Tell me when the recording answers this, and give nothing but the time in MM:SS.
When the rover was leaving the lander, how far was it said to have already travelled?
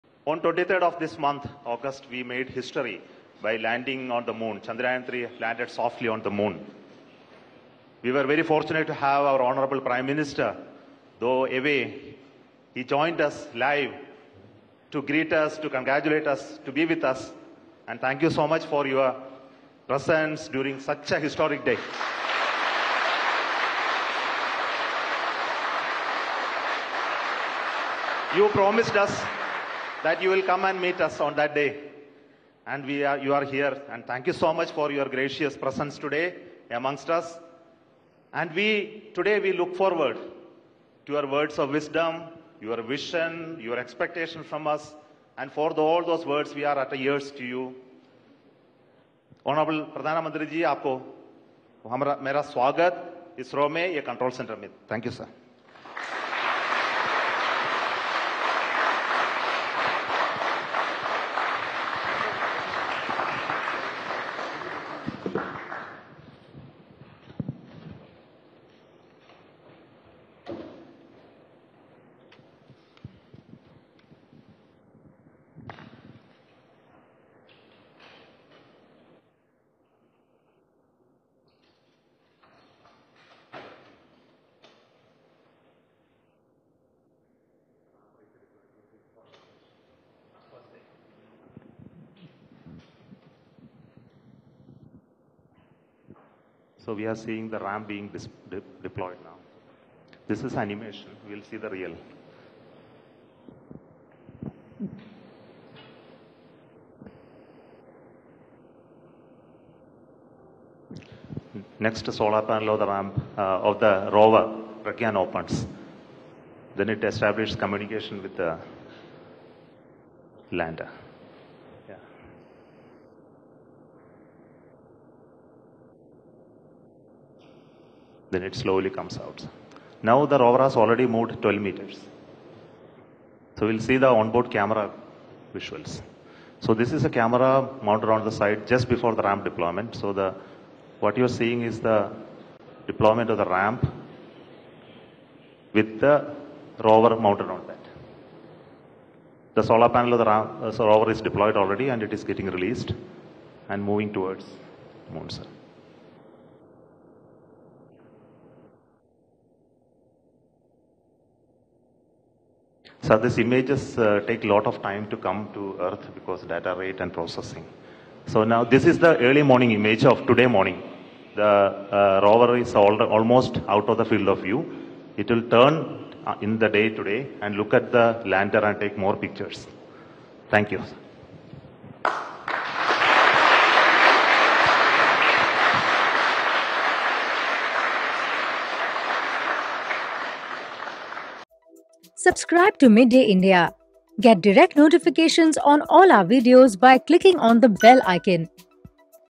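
02:11.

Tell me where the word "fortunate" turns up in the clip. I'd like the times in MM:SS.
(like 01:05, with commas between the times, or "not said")
00:08.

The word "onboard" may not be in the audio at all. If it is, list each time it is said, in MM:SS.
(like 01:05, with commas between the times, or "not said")
02:14.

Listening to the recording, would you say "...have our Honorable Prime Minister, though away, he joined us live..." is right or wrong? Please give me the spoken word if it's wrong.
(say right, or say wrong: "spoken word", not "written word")
right.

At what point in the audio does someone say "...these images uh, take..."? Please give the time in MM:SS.
02:43.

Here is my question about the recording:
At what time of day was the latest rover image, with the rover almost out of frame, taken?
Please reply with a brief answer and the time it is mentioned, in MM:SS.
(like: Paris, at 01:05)
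Early morning, at 02:49.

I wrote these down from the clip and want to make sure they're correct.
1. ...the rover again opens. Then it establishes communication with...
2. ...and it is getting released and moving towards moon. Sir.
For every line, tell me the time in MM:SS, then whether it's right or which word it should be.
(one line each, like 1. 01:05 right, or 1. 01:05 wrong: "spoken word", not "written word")
1. 01:53 right
2. 02:31 right.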